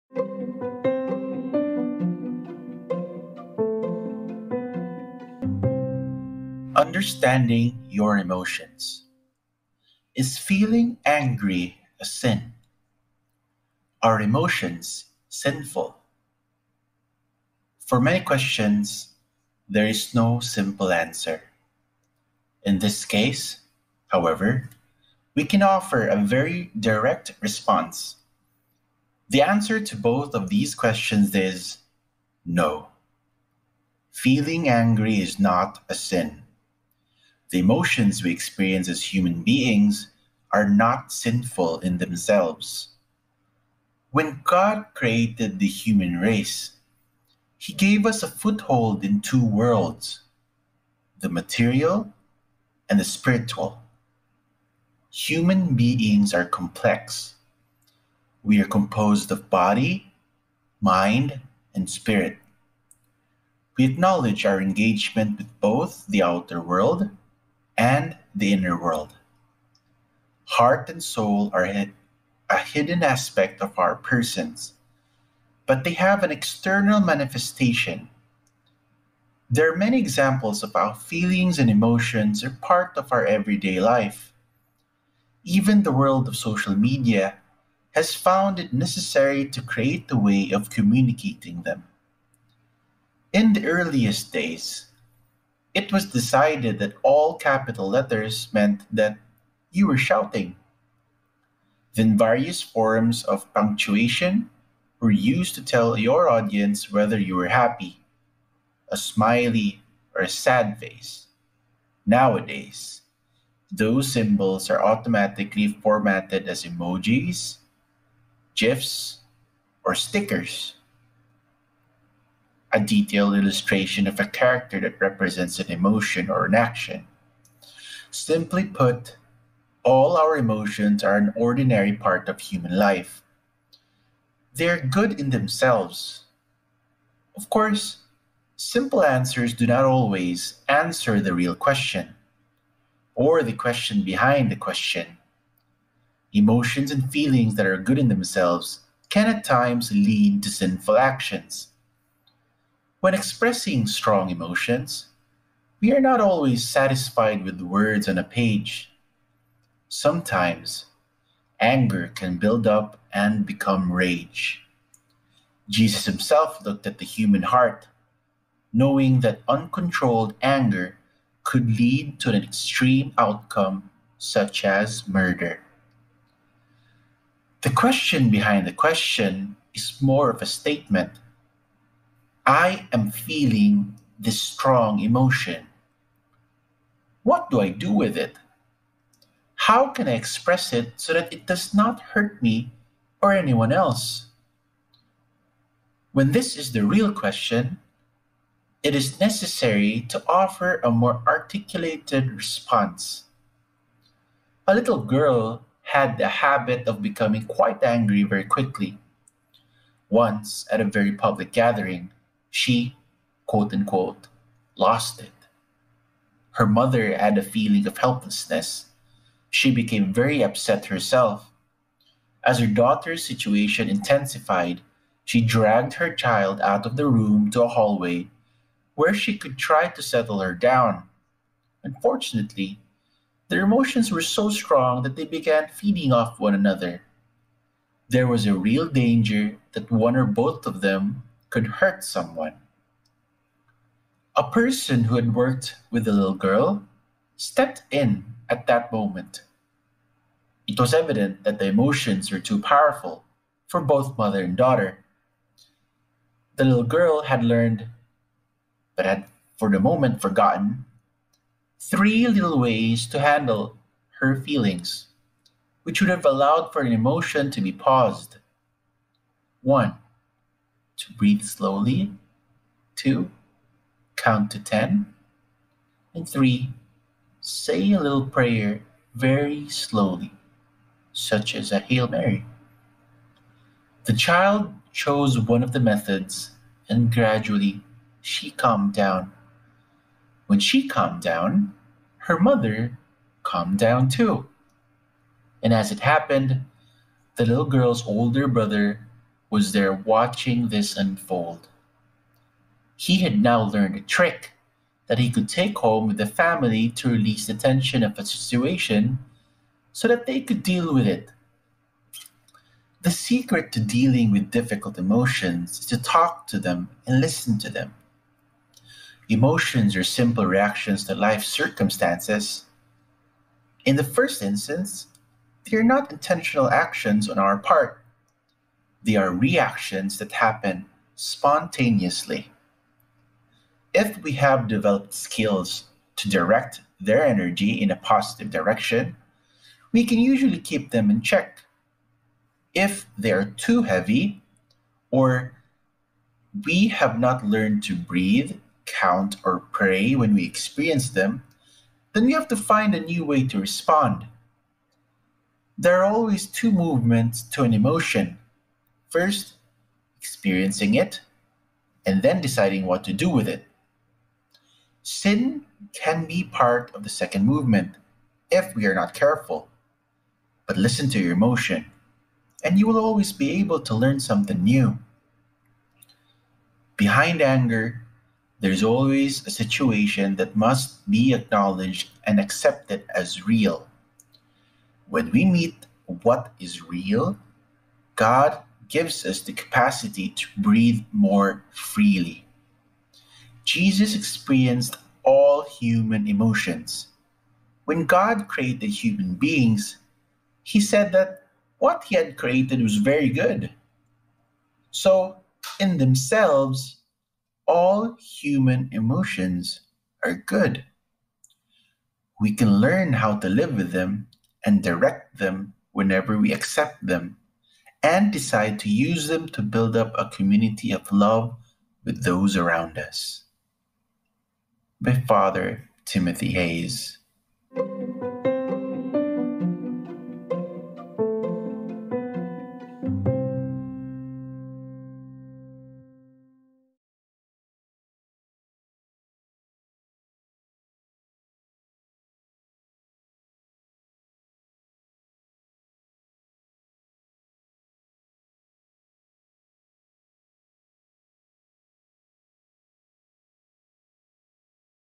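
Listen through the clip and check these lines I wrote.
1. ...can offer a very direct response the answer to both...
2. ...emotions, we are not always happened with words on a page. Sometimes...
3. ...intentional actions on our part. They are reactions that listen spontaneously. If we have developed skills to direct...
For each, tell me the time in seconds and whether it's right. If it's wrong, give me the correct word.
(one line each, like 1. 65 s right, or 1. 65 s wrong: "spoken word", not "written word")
1. 25 s right
2. 154 s wrong: "satisfied", not "happened"
3. 326 s wrong: "happen", not "listen".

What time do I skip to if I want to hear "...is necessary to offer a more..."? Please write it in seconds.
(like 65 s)
198 s.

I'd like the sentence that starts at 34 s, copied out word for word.
Feeling angry is not a sin.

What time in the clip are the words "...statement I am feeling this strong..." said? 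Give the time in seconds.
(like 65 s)
180 s.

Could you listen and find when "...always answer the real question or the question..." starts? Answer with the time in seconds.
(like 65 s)
139 s.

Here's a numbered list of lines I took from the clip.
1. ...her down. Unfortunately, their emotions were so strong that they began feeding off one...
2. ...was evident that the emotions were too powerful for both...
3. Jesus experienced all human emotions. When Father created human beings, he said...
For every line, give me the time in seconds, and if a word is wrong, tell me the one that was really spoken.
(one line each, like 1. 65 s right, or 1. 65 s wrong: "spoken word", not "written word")
1. 230 s right
2. 250 s right
3. 393 s wrong: "God", not "Father".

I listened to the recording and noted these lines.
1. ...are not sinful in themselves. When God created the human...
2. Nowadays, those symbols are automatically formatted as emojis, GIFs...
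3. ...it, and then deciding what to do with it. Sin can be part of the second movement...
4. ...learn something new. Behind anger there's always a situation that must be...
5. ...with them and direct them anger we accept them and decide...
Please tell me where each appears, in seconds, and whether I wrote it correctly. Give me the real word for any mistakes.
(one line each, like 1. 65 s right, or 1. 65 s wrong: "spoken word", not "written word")
1. 40 s right
2. 112 s right
3. 360 s right
4. 373 s right
5. 413 s wrong: "whenever", not "anger".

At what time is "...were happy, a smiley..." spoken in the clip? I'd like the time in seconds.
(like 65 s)
107 s.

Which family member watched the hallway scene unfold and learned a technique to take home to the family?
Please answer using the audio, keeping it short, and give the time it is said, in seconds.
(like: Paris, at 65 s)
older brother, at 298 s.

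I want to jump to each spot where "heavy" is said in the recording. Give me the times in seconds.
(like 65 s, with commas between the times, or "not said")
343 s.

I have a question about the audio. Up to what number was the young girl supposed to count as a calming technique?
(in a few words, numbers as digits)
10.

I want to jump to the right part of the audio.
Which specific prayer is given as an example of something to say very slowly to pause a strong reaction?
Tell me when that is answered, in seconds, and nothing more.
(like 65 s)
281 s.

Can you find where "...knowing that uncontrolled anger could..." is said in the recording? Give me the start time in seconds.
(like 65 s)
168 s.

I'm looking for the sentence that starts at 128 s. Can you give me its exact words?
Simply put, all our emotions are an ordinary part of human life.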